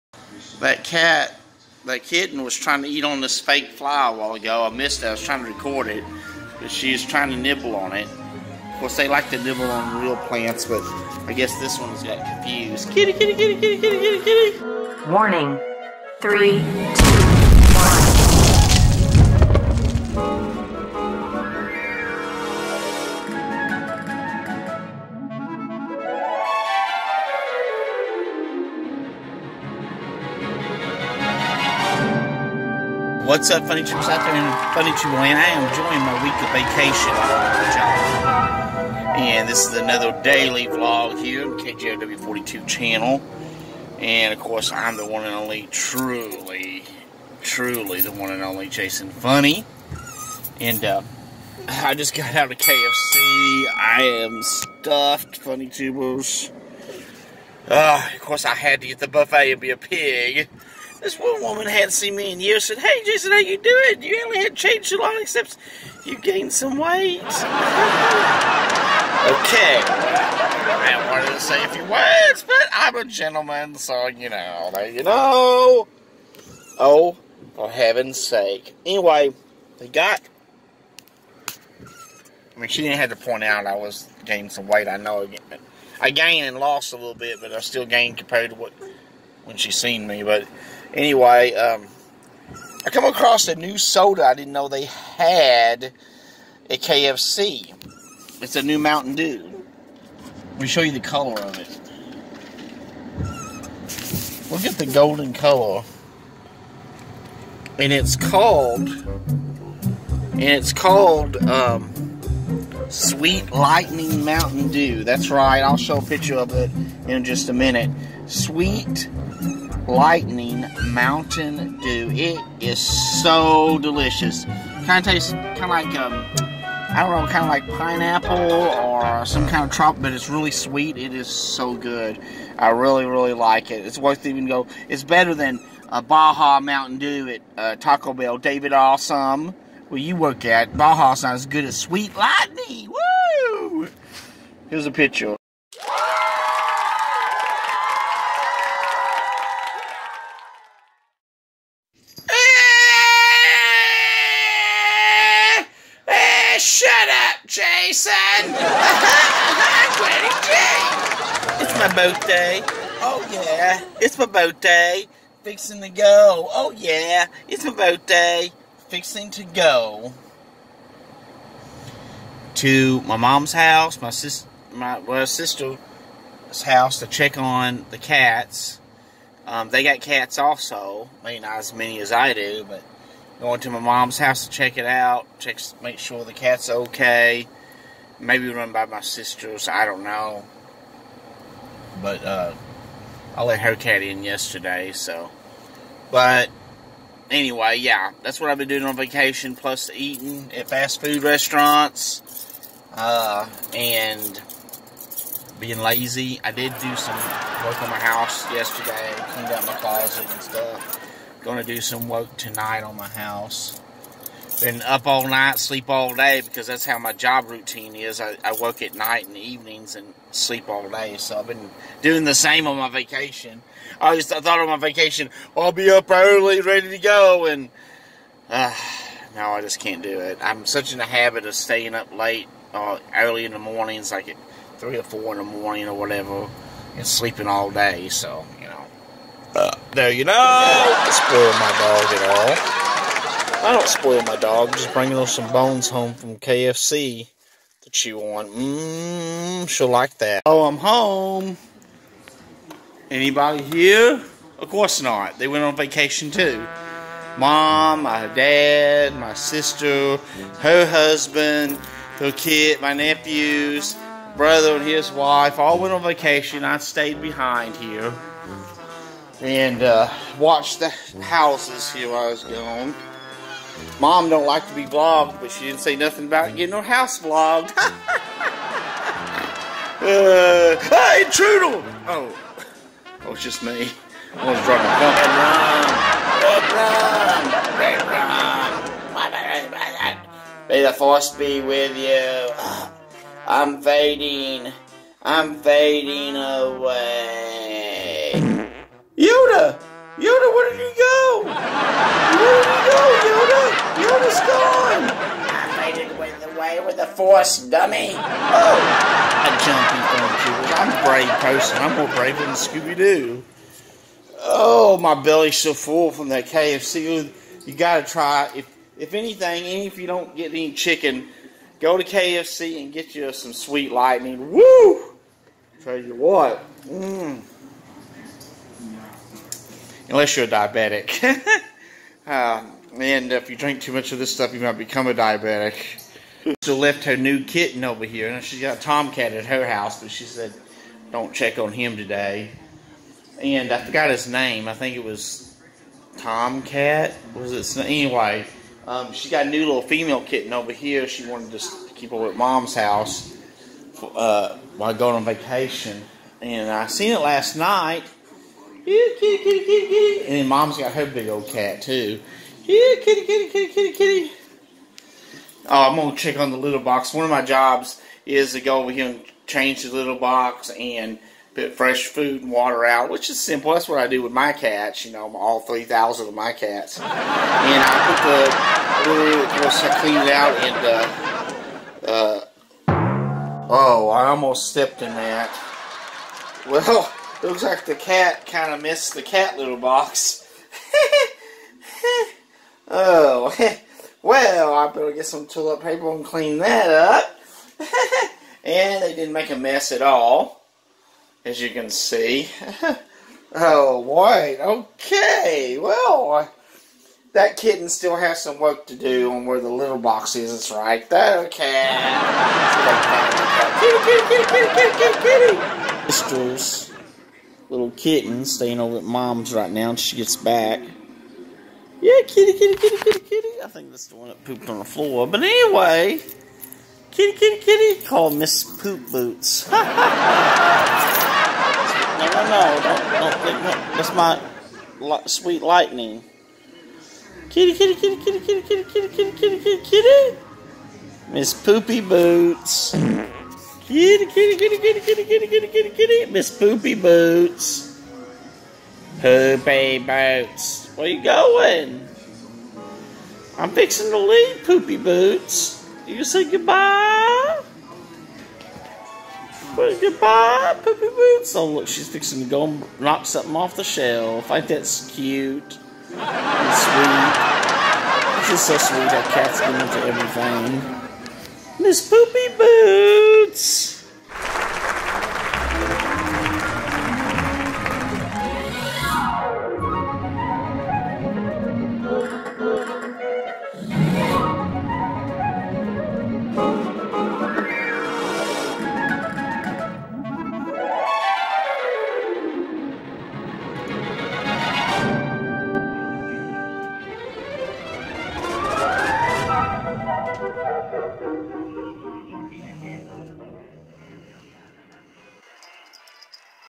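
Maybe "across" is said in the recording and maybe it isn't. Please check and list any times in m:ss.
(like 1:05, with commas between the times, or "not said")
1:33.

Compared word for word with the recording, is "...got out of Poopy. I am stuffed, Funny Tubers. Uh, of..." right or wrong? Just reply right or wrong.
wrong.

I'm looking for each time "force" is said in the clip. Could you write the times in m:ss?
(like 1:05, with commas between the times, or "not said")
4:50, 5:07.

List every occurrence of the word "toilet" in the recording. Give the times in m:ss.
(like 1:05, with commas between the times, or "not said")
6:35.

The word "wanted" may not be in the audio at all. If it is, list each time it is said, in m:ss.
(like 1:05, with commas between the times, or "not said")
1:11, 5:51.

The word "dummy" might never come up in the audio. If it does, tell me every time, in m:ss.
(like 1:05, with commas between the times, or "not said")
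5:07.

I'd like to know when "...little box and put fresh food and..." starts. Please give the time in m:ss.
6:09.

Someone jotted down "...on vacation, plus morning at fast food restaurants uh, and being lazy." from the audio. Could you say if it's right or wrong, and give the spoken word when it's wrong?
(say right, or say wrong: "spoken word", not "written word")
wrong: "eating", not "morning".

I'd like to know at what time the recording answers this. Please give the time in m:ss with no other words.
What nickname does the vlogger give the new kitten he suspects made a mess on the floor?
7:08.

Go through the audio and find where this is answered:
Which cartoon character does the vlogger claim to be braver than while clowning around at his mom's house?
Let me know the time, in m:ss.
5:12.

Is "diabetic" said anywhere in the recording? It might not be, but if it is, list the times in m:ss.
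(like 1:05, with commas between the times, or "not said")
5:30, 5:35.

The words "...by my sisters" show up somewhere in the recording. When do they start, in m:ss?
3:08.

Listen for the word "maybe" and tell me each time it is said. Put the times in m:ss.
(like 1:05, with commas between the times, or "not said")
3:01, 3:08.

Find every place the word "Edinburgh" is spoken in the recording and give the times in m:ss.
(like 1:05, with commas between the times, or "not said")
not said.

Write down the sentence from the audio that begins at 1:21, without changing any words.
I mean, she didn't have to point out I was gaining some weight.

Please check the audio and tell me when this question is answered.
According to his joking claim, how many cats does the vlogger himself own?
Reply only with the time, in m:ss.
6:15.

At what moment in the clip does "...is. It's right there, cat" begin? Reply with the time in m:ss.
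6:50.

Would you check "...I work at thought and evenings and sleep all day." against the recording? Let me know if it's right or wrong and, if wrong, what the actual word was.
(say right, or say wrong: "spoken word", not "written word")
wrong: "night", not "thought".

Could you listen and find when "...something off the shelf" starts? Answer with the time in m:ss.
7:43.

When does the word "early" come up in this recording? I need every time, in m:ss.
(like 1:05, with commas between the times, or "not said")
3:46, 3:53.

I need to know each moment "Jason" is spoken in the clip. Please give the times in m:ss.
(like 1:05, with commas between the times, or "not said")
0:48, 1:03.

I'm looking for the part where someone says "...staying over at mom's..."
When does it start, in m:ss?
6:58.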